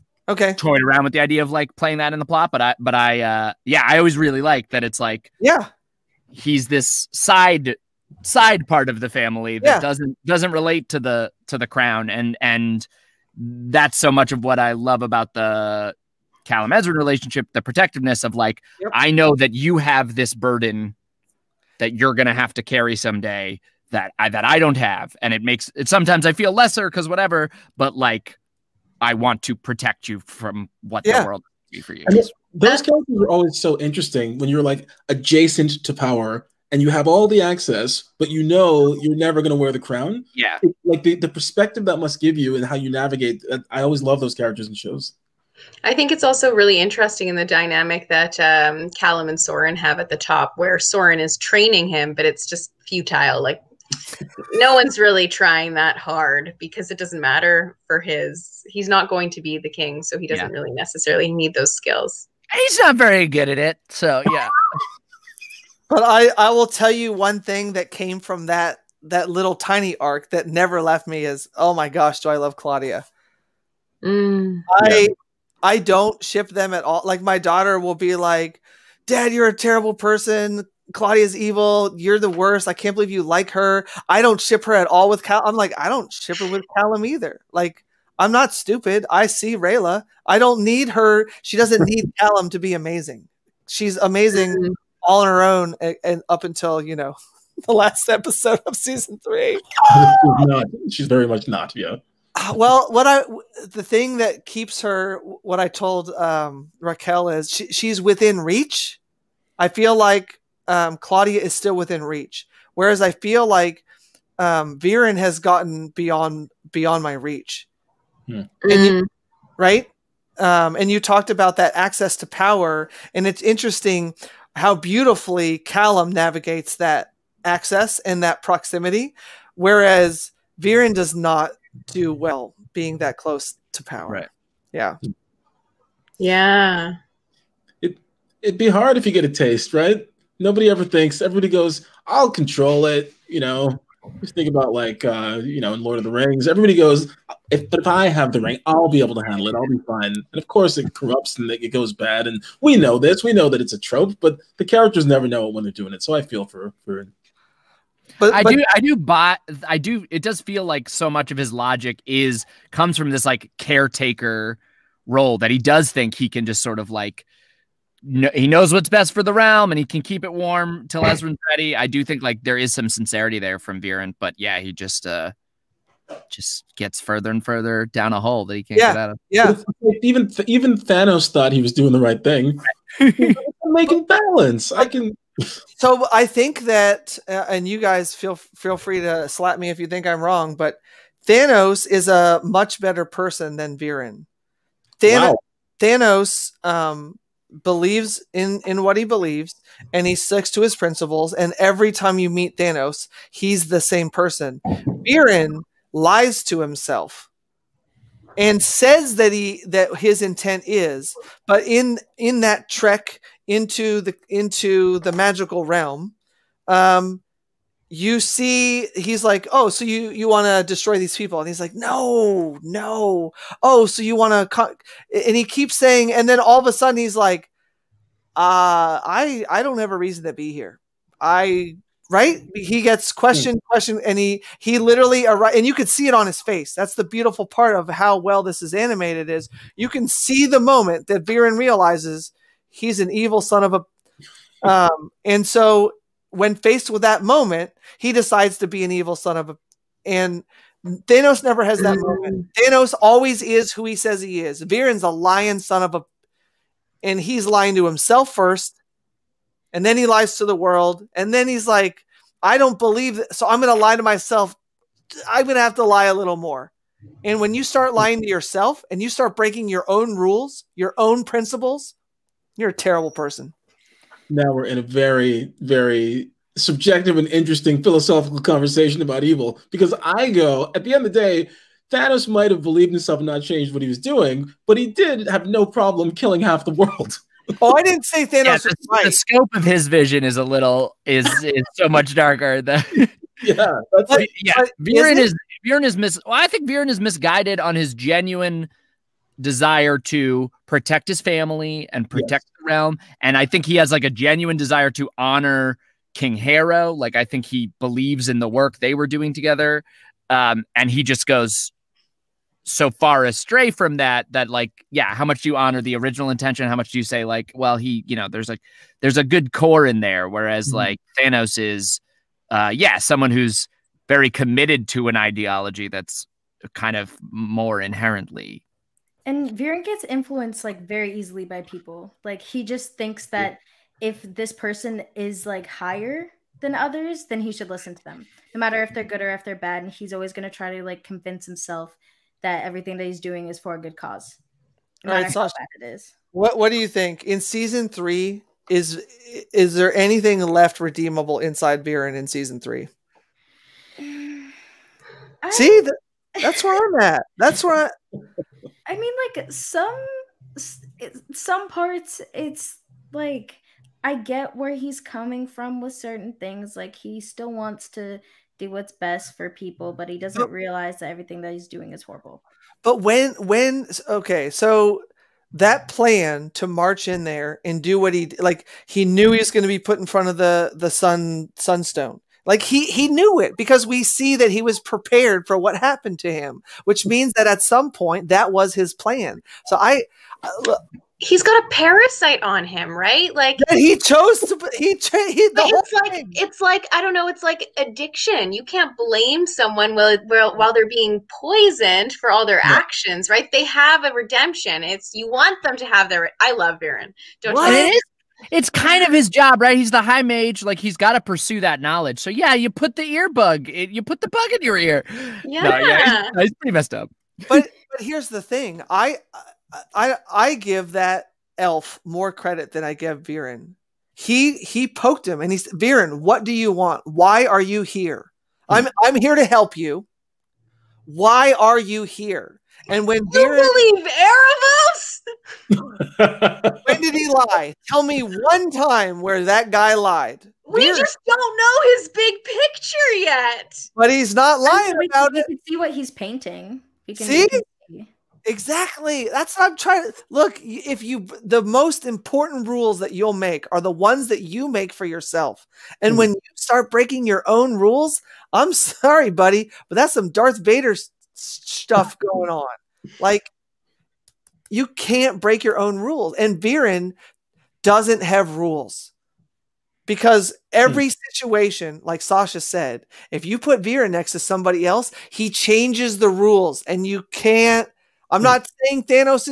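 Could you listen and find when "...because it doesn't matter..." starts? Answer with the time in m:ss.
0:56.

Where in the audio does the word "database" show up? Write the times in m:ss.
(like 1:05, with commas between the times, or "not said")
not said.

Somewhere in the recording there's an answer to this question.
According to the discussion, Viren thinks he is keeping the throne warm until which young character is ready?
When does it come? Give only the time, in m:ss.
2:51.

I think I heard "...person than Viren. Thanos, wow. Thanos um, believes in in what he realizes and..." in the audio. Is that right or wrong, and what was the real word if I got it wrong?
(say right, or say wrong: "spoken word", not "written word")
wrong: "believes", not "realizes".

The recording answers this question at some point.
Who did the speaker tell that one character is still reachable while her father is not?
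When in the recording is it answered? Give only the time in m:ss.
1:46.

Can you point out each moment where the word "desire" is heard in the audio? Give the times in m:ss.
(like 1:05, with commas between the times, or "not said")
4:59, 5:04.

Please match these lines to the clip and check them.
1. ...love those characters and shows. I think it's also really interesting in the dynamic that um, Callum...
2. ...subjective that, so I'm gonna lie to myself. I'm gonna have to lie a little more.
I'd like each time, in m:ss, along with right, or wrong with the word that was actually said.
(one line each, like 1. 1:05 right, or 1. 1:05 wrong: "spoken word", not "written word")
1. 0:44 right
2. 4:22 wrong: "believe", not "subjective".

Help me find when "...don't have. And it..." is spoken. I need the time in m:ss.
0:24.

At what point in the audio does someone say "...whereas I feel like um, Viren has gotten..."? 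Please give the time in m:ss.
1:52.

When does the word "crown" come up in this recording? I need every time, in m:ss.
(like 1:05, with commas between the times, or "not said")
0:11, 0:39.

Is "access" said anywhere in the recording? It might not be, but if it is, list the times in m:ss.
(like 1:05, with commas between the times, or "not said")
0:37, 2:01, 2:07.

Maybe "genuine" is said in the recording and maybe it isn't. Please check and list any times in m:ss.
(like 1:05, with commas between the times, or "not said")
4:57, 5:04.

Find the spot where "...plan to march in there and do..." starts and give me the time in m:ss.
6:15.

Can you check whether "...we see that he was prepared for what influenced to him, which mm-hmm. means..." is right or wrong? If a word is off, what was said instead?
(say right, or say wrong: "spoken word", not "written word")
wrong: "happened", not "influenced".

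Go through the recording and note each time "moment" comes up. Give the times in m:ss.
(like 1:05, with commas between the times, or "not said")
4:00, 4:07, 4:11.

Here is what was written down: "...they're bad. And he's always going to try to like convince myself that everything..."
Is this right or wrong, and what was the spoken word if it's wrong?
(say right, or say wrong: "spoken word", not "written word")
wrong: "himself", not "myself".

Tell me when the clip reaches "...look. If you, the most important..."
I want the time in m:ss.
7:30.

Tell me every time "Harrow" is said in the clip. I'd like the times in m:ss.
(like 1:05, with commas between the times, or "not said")
5:06.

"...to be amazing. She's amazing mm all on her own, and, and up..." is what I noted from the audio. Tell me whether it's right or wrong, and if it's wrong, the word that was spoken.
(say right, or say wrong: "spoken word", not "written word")
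right.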